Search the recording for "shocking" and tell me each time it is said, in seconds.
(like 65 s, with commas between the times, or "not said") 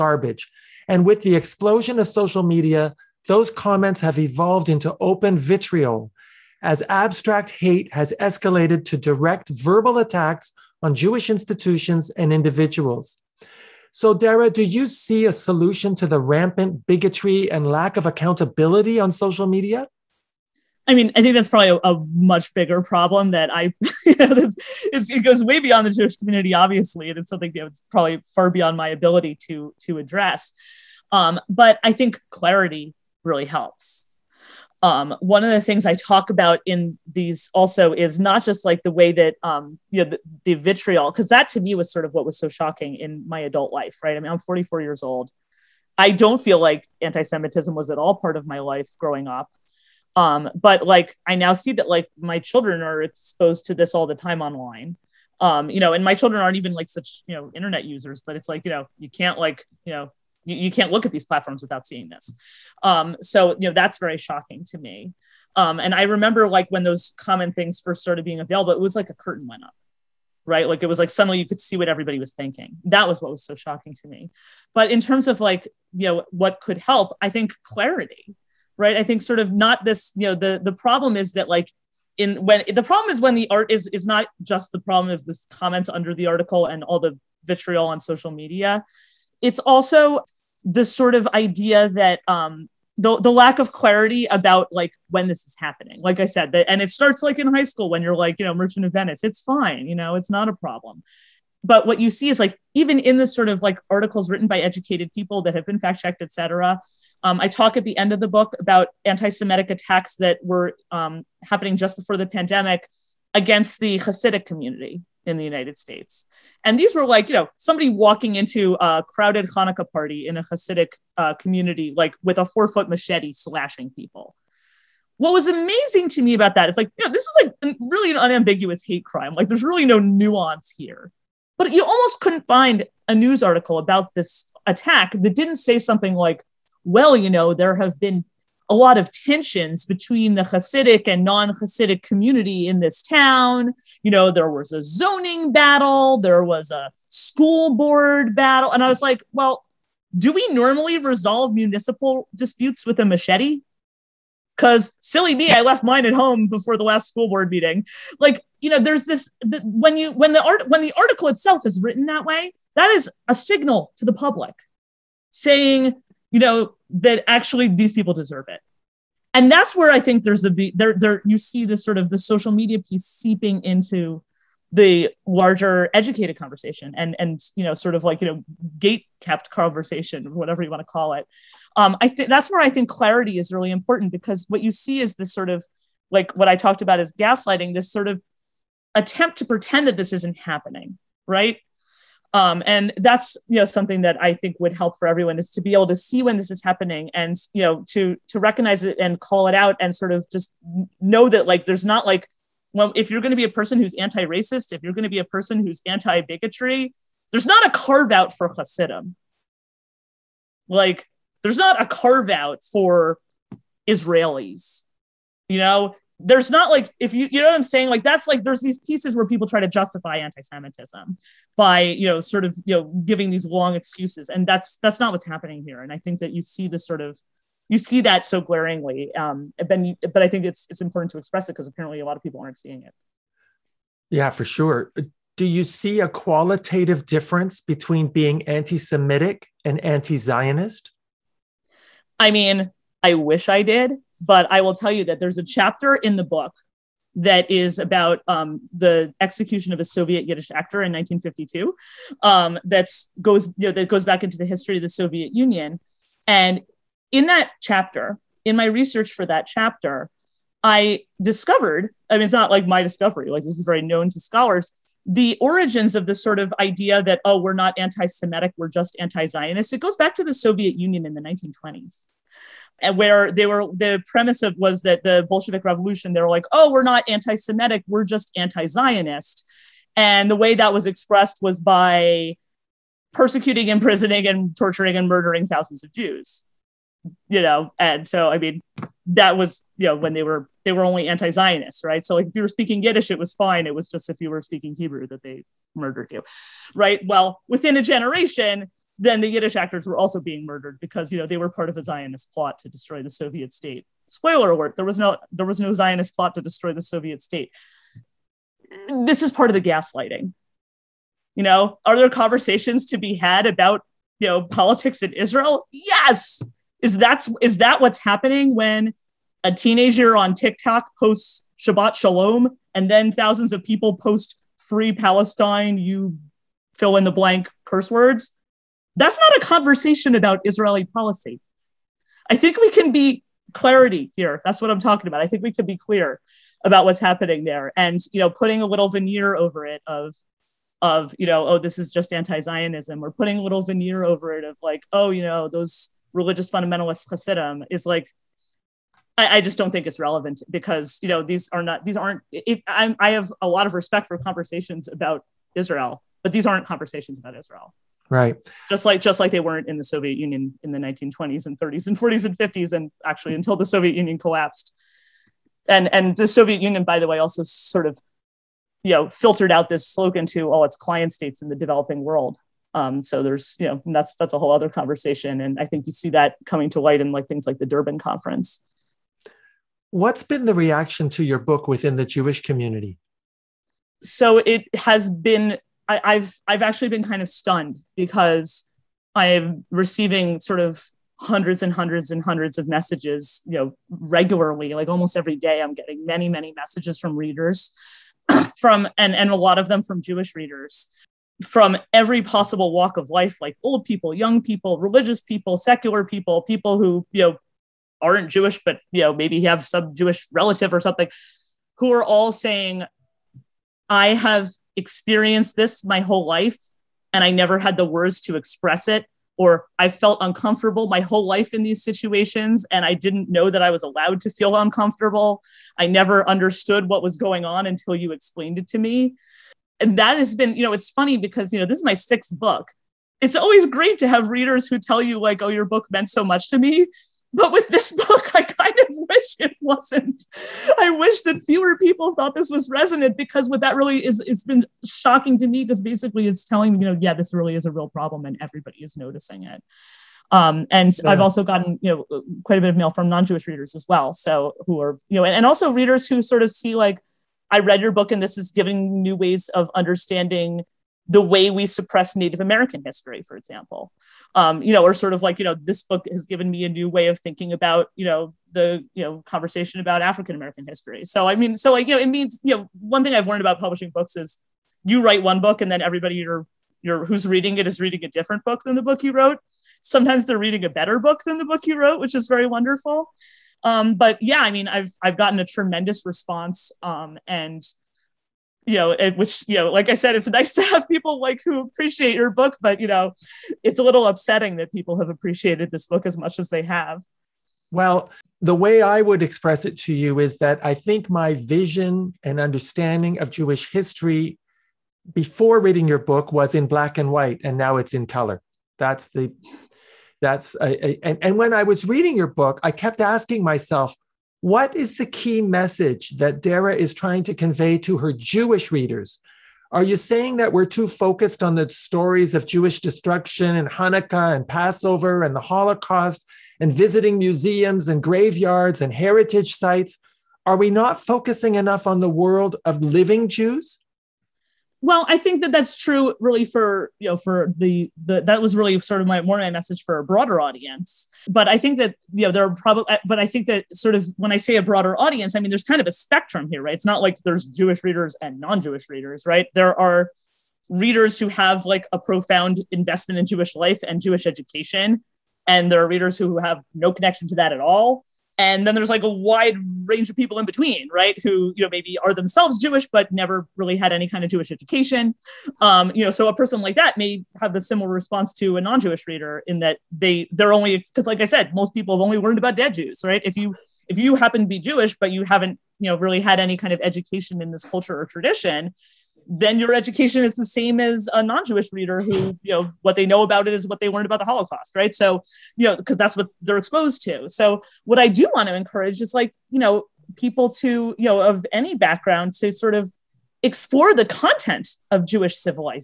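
42 s, 64 s, 73 s, 444 s.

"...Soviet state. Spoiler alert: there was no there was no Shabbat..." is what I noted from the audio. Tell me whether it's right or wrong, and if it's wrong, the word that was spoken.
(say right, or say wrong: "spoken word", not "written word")
wrong: "Zionist", not "Shabbat".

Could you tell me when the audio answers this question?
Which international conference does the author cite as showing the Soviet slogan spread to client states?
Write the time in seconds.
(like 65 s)
377 s.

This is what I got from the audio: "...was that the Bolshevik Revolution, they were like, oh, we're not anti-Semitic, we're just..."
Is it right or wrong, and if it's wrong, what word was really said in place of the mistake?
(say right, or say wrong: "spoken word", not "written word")
right.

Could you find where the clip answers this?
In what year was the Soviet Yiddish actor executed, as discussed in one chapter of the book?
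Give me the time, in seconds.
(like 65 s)
250 s.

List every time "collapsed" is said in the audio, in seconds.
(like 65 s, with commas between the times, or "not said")
364 s.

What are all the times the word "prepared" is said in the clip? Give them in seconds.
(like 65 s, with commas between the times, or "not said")
not said.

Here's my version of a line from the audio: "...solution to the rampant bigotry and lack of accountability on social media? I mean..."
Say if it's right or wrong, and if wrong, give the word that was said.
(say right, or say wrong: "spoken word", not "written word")
right.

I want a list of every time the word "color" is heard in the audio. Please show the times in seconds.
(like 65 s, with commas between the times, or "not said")
508 s.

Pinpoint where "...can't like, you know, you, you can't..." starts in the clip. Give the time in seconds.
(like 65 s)
59 s.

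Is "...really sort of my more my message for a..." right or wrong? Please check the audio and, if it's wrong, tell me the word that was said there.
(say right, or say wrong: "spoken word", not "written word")
right.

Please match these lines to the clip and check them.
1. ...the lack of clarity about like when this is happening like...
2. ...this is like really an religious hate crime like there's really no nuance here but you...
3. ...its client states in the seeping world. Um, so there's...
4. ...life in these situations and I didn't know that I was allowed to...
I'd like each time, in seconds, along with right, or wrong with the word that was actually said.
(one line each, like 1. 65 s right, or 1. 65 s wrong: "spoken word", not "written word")
1. 93 s right
2. 127 s wrong: "unambiguous", not "religious"
3. 370 s wrong: "developing", not "seeping"
4. 421 s right.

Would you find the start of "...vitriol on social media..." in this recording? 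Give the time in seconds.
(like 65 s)
87 s.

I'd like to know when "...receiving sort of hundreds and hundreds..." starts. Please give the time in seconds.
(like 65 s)
389 s.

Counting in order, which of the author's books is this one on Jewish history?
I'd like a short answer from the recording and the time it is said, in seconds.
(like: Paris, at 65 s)
6th, at 431 s.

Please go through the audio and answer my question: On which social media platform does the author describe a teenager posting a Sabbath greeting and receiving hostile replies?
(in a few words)
TikTok.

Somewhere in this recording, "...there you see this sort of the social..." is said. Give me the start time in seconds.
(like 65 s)
170 s.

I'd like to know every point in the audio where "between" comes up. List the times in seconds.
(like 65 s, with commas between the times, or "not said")
139 s, 237 s, 560 s.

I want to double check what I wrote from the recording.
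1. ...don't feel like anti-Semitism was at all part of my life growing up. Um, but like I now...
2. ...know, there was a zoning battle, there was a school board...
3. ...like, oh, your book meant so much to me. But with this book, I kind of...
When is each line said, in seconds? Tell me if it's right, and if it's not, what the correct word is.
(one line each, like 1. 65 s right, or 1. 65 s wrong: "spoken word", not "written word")
1. 46 s right
2. 144 s right
3. 435 s right.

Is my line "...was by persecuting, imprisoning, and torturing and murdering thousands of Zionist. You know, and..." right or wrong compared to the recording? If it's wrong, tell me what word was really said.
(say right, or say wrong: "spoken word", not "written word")
wrong: "Jews", not "Zionist".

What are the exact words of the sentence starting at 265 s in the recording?
The origins of this sort of idea that oh, we're not anti-Semitic, we're just anti-Zionist.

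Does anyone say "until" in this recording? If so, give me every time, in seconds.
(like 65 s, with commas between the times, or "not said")
363 s, 427 s.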